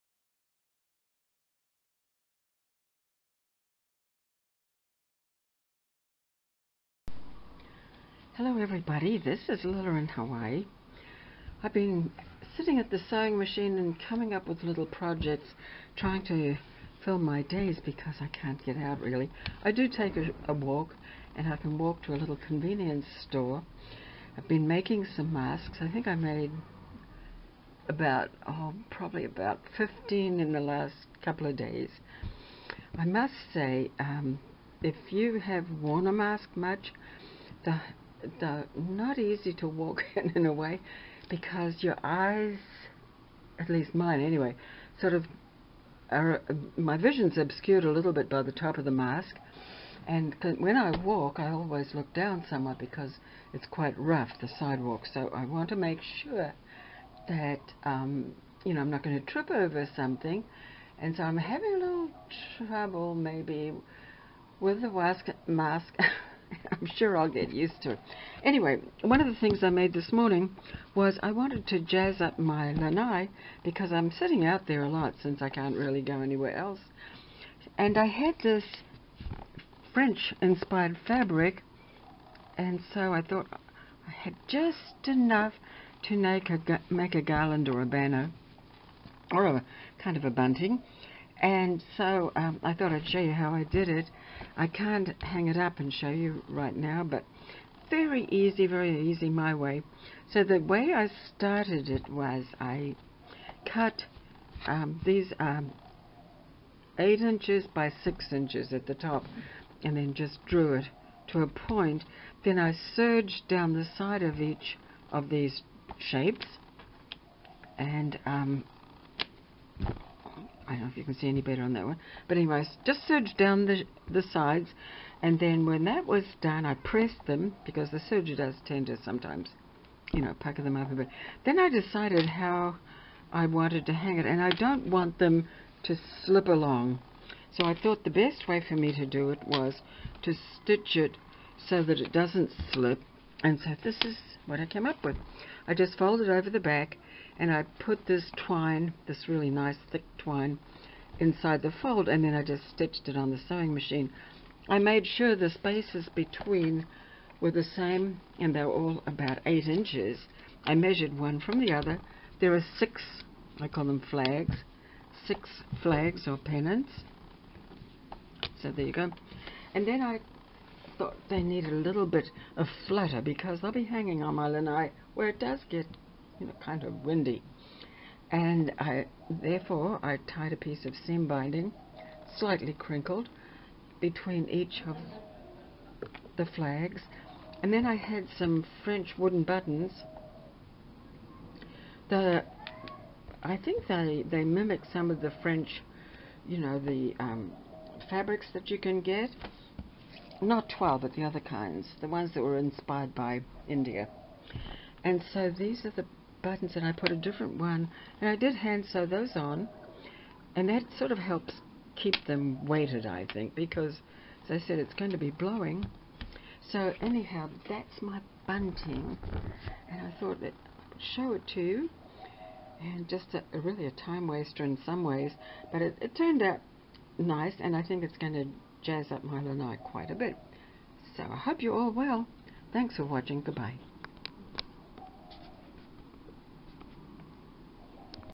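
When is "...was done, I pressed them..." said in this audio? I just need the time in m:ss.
2:06.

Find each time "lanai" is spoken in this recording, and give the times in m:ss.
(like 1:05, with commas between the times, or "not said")
1:12, 2:54, 3:49.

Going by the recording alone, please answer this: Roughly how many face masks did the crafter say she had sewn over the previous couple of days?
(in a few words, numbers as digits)
15.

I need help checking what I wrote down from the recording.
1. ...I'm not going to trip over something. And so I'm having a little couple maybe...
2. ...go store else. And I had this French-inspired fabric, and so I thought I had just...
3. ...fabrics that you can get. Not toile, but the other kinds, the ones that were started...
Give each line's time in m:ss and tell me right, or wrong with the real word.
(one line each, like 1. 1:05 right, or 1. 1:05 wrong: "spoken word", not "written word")
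1. 0:58 wrong: "trouble", not "couple"
2. 1:16 wrong: "anywhere", not "store"
3. 3:18 wrong: "inspired", not "started".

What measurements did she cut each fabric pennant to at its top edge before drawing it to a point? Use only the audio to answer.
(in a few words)
8 inches by 6 inches.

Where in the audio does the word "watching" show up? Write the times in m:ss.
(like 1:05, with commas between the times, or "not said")
3:53.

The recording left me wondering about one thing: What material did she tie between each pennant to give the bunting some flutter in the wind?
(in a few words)
seam binding.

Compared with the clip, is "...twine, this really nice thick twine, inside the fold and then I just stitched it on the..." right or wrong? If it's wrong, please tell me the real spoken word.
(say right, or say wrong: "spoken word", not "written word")
right.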